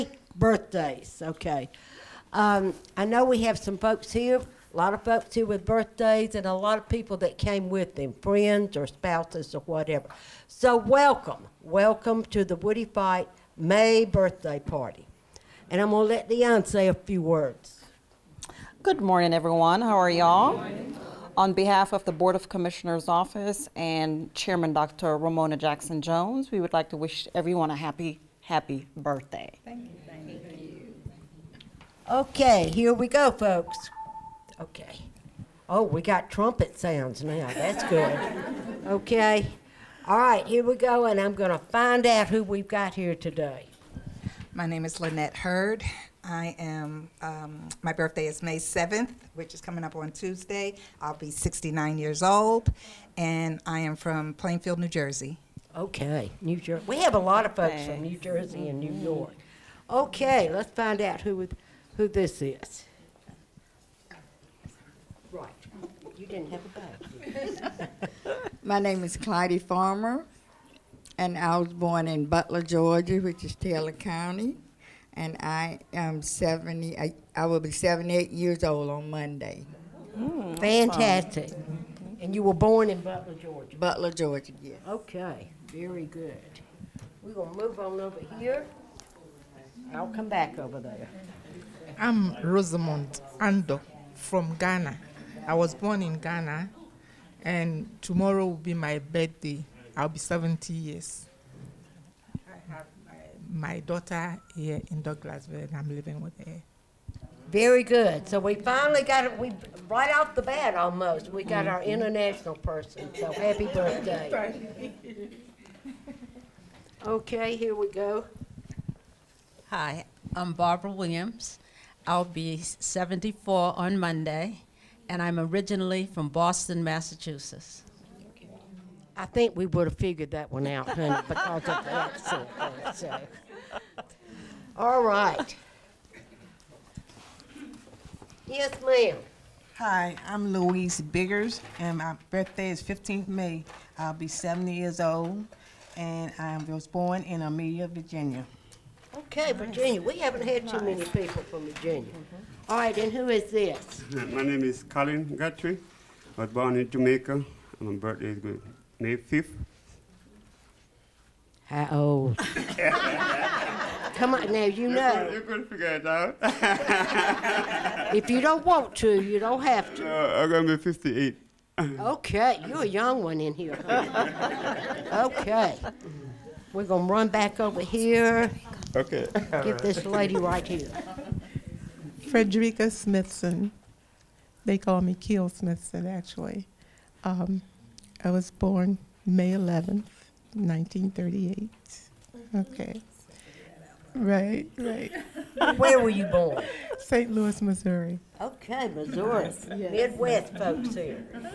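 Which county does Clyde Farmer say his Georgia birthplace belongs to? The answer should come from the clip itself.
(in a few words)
Taylor County.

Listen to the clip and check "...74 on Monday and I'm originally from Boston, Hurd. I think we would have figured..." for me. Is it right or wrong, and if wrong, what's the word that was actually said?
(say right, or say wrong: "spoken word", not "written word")
wrong: "Massachusetts", not "Hurd".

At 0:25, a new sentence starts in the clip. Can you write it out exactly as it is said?
Romona Jackson Jones, we would like to wish everyone a happy, happy birthday.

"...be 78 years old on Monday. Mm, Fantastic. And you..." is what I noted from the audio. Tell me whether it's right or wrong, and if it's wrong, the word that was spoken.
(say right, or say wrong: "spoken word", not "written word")
right.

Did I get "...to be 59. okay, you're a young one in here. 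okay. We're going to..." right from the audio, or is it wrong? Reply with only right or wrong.
wrong.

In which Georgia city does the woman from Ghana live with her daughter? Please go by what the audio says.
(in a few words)
Douglasville.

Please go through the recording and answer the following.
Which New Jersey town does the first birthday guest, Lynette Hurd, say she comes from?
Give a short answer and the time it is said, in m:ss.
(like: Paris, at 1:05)
Plainfield, at 0:54.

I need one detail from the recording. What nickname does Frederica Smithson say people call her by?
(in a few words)
Keel.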